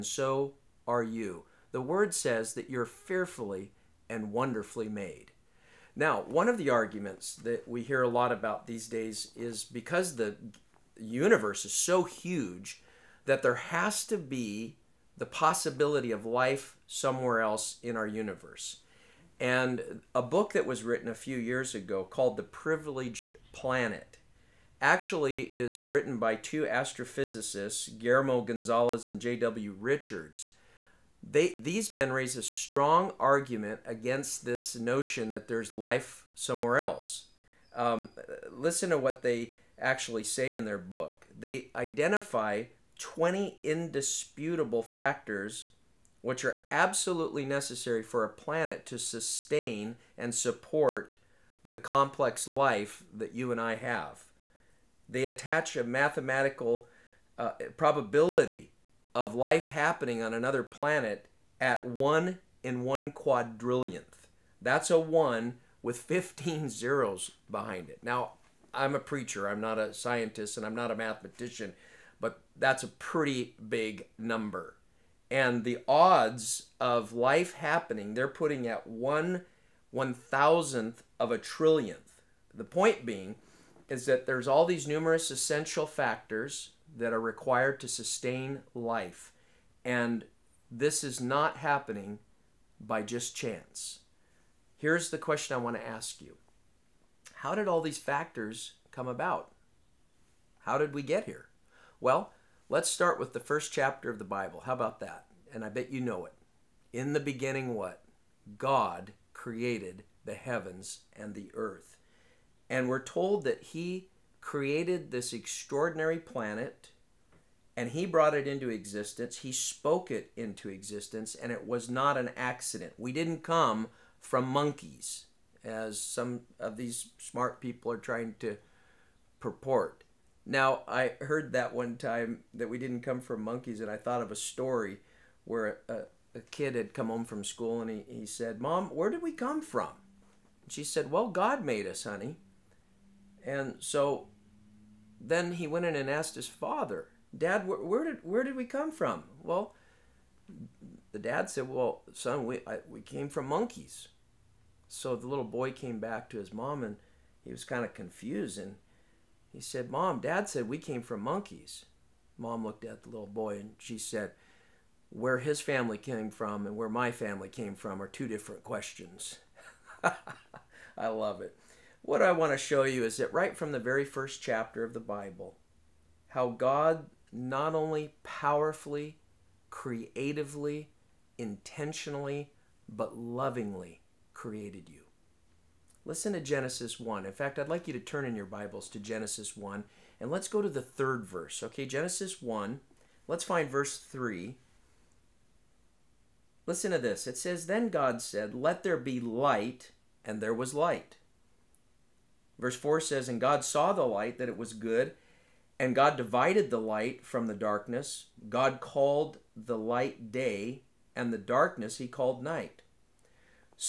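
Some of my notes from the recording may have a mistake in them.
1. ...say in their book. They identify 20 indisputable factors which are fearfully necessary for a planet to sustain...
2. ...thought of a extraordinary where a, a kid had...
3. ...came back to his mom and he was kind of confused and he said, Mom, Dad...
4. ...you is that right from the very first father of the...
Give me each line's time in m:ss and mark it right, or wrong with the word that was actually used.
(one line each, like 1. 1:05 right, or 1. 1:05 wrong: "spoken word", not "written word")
1. 0:40 wrong: "absolutely", not "fearfully"
2. 2:13 wrong: "story", not "extraordinary"
3. 2:35 right
4. 2:52 wrong: "chapter", not "father".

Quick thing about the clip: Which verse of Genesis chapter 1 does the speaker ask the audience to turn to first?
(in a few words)
3.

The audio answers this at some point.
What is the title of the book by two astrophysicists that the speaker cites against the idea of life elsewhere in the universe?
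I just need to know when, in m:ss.
0:22.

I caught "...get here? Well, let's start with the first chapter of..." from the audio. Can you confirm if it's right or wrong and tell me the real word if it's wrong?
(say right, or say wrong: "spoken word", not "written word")
right.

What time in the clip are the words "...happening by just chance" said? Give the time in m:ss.
1:31.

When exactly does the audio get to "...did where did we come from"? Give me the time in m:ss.
2:28.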